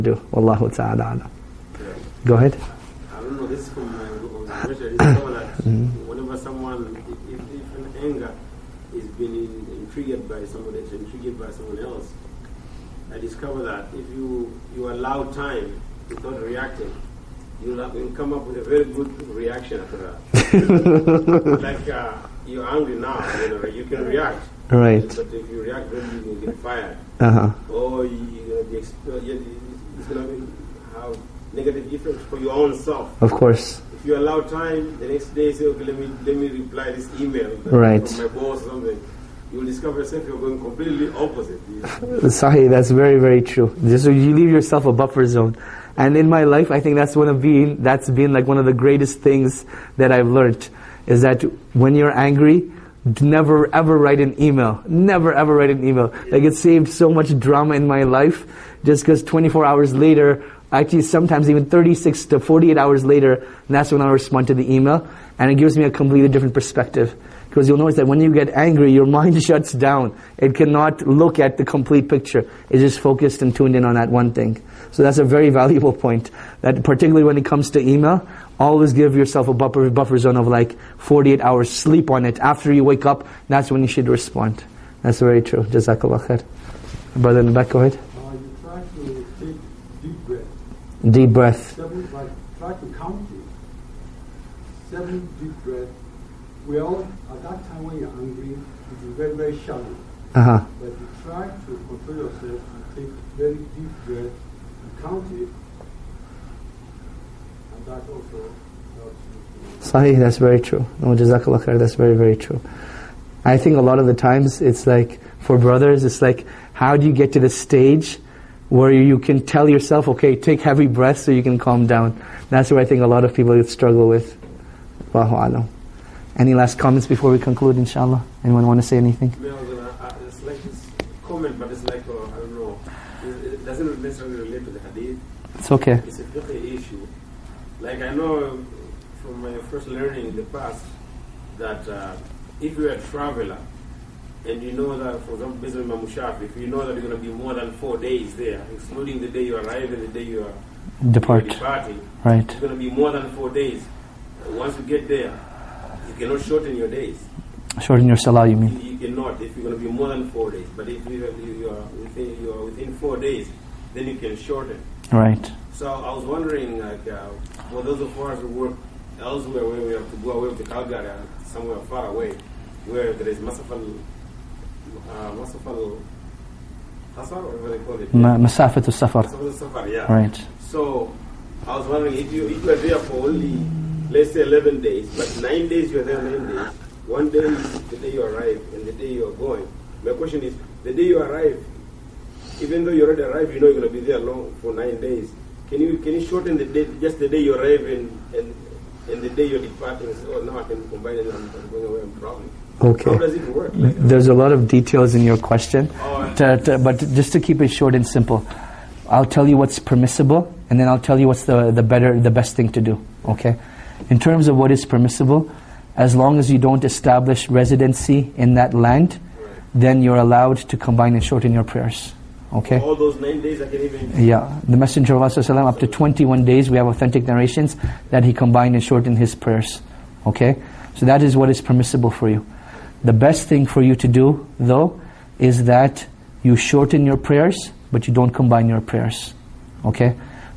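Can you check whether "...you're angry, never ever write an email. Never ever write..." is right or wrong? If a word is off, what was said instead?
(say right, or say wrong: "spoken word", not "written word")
right.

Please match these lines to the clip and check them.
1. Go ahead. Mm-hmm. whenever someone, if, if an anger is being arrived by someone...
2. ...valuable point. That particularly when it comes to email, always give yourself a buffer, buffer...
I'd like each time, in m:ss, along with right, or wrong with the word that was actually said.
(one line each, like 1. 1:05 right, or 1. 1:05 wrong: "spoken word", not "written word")
1. 0:02 wrong: "triggered", not "arrived"
2. 1:15 right.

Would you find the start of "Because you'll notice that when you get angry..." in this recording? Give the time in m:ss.
1:07.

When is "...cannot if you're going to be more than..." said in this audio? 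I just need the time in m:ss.
2:38.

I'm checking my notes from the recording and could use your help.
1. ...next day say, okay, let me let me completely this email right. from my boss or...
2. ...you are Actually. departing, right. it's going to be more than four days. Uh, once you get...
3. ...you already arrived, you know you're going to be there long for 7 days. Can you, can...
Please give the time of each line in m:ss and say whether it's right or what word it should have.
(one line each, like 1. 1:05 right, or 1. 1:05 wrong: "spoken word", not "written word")
1. 0:35 wrong: "reply", not "completely"
2. 2:30 wrong: "Depart", not "Actually"
3. 3:12 wrong: "9", not "7".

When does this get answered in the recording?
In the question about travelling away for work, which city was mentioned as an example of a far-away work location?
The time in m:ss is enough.
2:50.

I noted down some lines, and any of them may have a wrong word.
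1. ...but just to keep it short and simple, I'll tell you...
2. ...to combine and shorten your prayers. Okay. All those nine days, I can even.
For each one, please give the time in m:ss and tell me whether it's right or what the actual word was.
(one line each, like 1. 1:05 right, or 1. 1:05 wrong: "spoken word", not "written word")
1. 3:26 right
2. 3:40 right.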